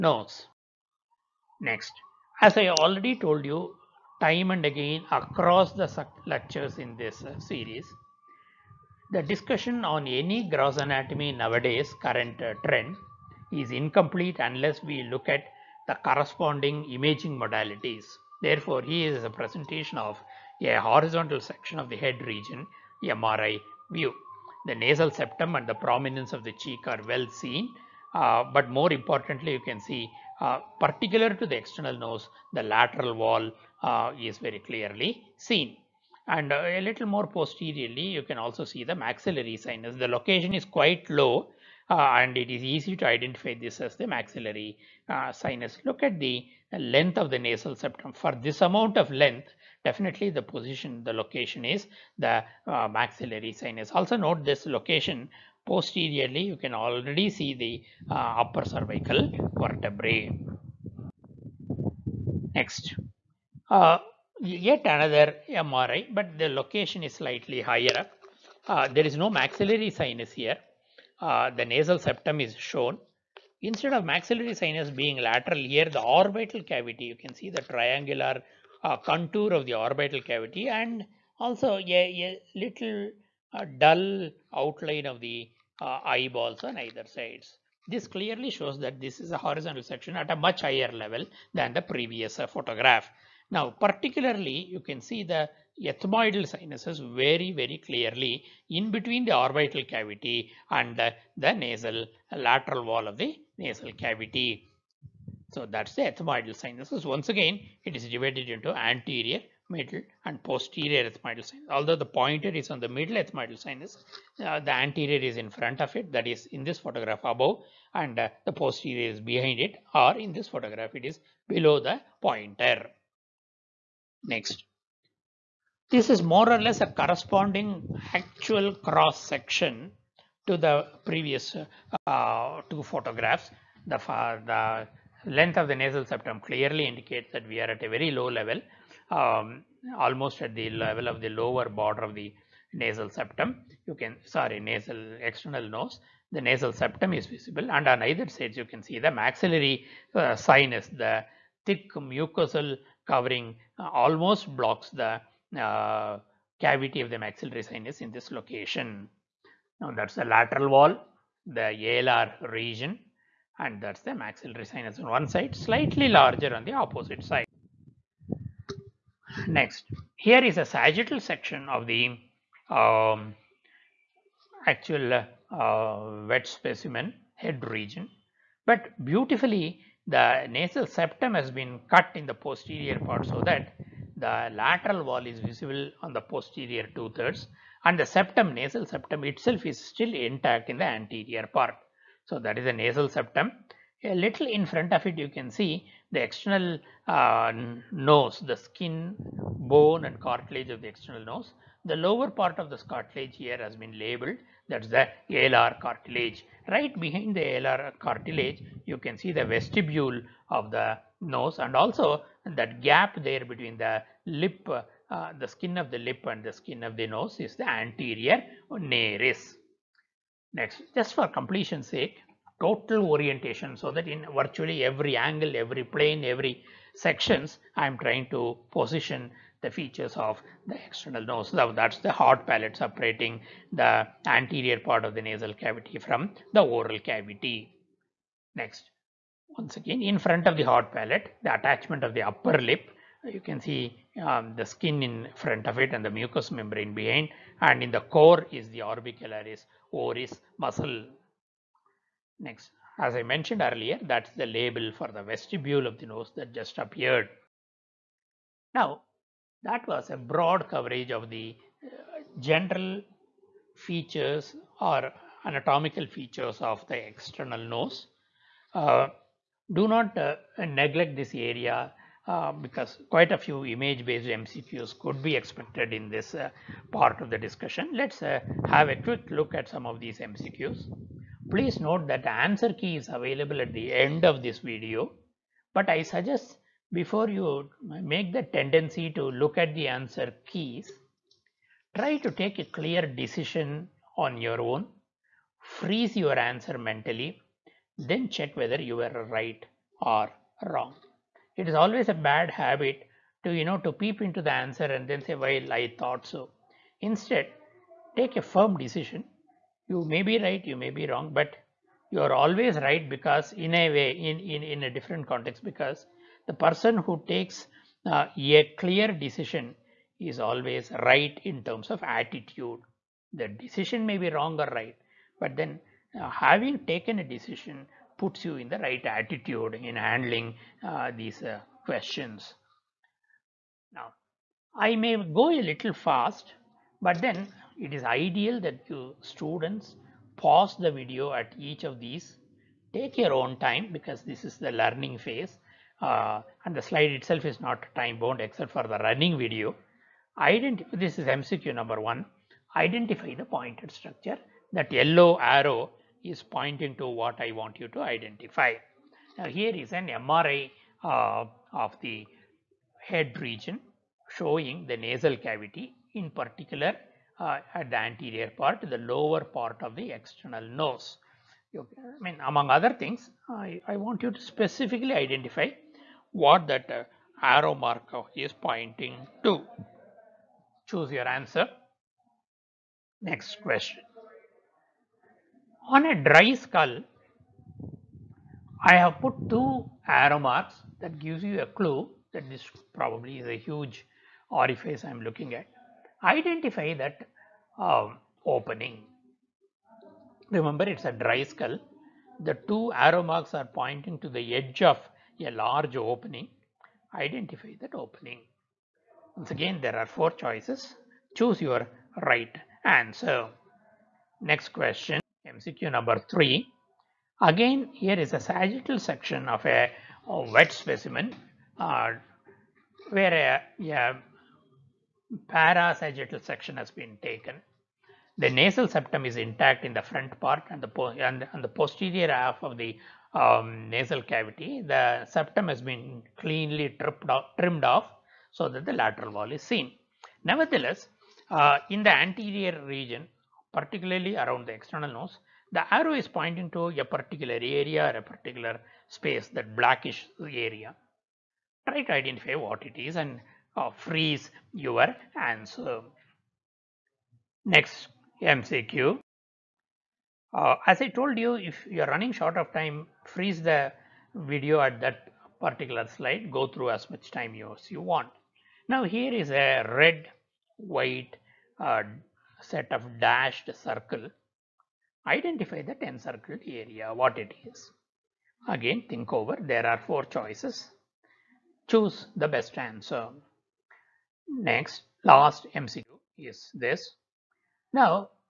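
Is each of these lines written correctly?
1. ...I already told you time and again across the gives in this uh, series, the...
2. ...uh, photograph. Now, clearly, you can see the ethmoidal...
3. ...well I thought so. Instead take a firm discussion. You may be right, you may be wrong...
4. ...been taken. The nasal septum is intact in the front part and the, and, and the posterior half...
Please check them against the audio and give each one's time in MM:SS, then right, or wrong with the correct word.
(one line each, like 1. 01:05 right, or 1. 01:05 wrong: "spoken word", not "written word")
1. 00:02 wrong: "lectures", not "gives"
2. 01:32 wrong: "particularly", not "clearly"
3. 05:05 wrong: "decision", not "discussion"
4. 07:06 right.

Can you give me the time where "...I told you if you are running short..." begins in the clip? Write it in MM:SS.
07:41.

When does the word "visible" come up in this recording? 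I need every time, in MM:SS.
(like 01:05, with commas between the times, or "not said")
02:27, 03:05.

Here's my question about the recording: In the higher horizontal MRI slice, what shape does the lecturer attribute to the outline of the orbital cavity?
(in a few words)
triangular.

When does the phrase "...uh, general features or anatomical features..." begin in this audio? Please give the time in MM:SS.
04:21.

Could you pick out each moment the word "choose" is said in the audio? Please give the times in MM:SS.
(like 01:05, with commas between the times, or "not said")
06:20, 06:51, 08:01.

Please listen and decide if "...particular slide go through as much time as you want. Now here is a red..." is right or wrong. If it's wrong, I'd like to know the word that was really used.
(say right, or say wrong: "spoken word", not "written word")
right.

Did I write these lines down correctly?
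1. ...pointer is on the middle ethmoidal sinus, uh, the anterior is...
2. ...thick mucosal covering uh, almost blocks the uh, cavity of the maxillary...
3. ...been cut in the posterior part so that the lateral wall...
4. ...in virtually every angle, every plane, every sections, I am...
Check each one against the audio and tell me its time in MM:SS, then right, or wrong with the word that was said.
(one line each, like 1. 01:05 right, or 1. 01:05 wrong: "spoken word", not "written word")
1. 01:52 right
2. 02:31 right
3. 03:01 right
4. 03:44 right.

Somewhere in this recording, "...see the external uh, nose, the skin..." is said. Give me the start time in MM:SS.
03:15.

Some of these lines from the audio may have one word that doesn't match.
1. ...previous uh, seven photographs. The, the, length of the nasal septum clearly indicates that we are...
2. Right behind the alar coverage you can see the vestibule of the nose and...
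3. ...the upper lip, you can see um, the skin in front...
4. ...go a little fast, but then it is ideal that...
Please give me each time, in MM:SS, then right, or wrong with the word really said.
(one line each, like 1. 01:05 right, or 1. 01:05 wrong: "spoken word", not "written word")
1. 02:11 wrong: "two", not "seven"
2. 03:26 wrong: "cartilage", not "coverage"
3. 04:02 right
4. 05:35 right.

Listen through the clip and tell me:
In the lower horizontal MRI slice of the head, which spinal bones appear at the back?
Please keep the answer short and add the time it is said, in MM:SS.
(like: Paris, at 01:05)
upper cervical vertebrae, at 00:58.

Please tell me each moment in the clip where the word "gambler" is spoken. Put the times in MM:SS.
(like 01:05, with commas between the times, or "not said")
not said.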